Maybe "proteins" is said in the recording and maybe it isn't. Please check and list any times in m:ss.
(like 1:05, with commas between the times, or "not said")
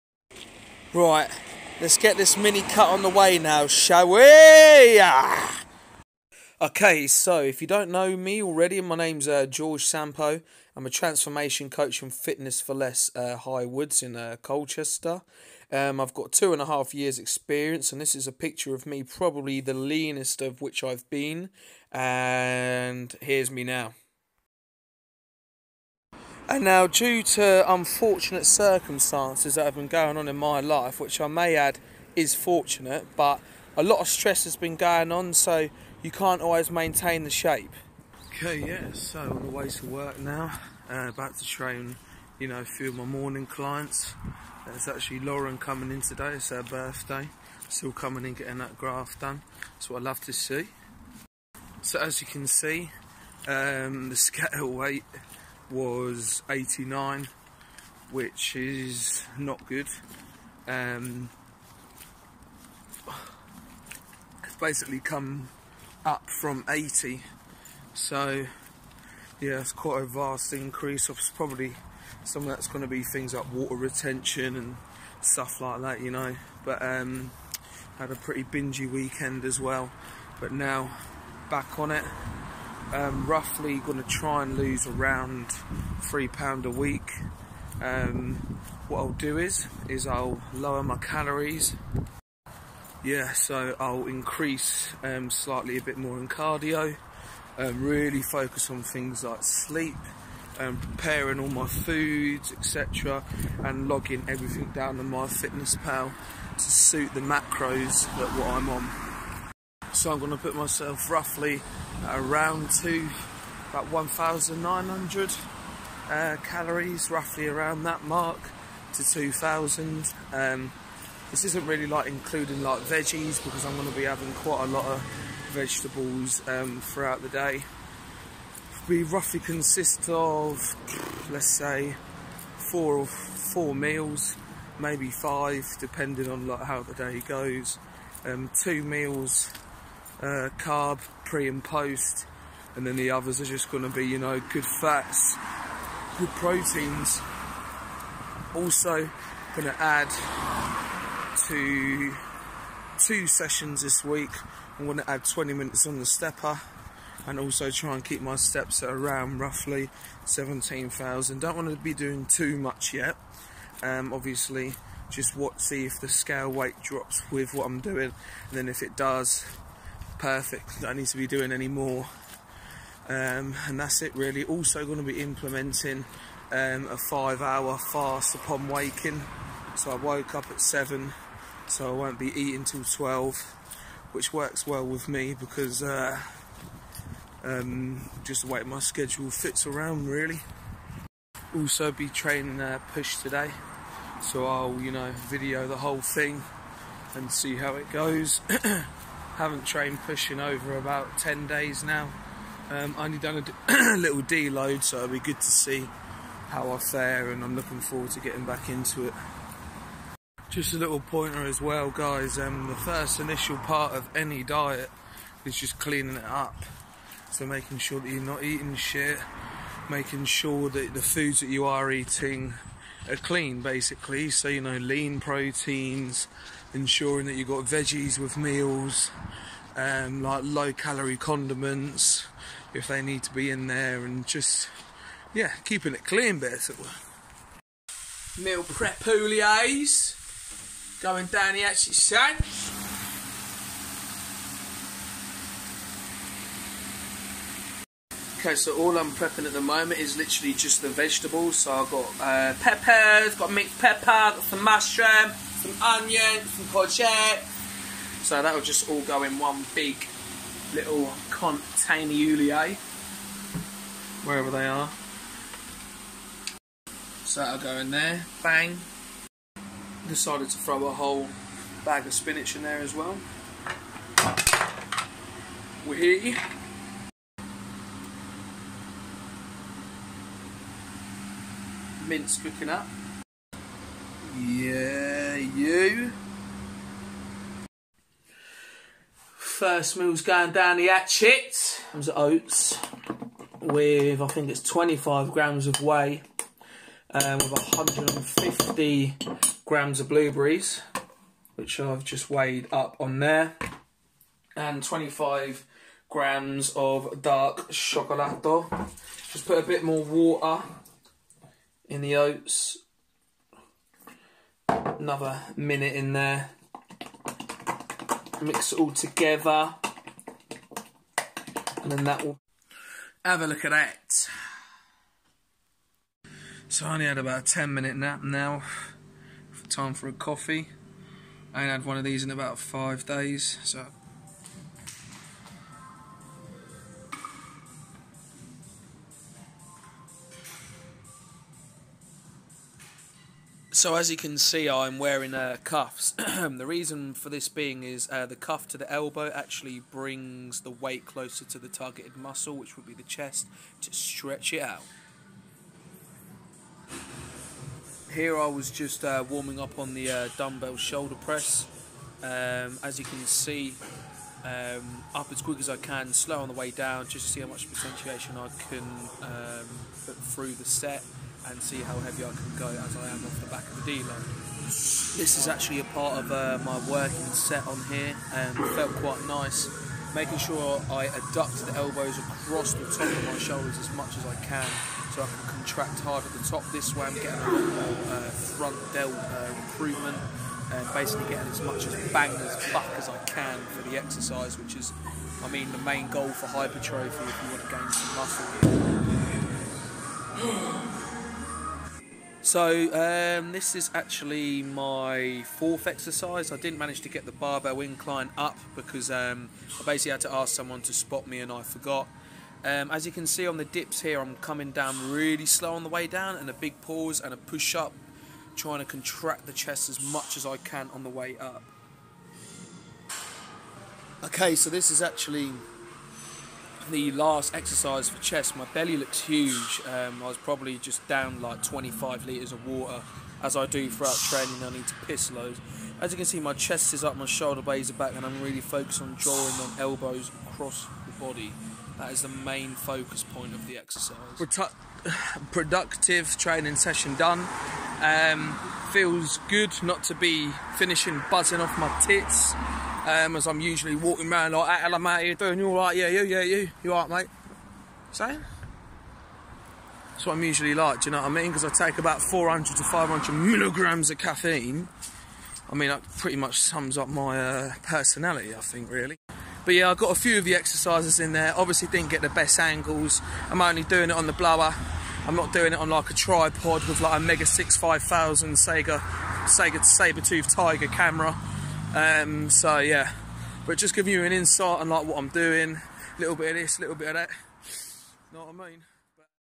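2:26, 3:45.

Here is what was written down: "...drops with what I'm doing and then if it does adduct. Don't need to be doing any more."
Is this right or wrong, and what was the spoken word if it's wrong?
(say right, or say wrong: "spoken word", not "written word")
wrong: "perfect", not "adduct".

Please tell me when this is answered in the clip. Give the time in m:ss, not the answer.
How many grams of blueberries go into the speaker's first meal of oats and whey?
4:57.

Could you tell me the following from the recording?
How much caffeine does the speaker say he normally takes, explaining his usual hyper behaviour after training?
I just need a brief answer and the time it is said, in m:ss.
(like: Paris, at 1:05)
400 to 500 milligrams, at 7:42.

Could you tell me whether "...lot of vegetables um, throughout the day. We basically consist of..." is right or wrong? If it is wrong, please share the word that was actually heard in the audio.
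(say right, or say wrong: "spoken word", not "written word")
wrong: "roughly", not "basically".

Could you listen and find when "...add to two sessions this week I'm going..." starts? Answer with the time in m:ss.
2:29.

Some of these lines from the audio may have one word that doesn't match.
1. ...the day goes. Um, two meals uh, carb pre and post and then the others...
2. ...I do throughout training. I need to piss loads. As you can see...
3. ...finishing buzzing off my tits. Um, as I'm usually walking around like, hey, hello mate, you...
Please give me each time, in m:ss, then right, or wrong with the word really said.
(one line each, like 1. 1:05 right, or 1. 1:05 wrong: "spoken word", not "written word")
1. 2:16 right
2. 7:13 right
3. 7:30 right.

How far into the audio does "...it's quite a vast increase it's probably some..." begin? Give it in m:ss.
1:09.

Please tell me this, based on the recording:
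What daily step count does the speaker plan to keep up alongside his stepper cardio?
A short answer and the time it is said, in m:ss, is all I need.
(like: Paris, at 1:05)
17,000, at 2:40.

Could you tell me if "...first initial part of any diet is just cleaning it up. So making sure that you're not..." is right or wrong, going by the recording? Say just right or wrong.
right.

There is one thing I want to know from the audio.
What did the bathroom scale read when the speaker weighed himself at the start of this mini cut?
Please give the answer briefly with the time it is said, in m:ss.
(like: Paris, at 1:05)
89, at 0:56.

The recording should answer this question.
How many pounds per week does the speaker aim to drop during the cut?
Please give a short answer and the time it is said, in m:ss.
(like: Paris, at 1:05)
3 pounds, at 1:26.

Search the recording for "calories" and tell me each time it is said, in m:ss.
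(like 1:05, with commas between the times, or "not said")
1:30, 1:56, 3:50.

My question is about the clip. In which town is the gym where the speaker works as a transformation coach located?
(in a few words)
Colchester.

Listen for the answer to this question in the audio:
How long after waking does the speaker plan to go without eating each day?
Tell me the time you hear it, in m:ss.
2:57.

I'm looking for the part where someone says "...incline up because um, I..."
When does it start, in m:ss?
6:47.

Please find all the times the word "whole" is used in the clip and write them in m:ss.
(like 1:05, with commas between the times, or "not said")
3:15, 4:30.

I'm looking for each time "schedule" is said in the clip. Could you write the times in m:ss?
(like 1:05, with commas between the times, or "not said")
3:08.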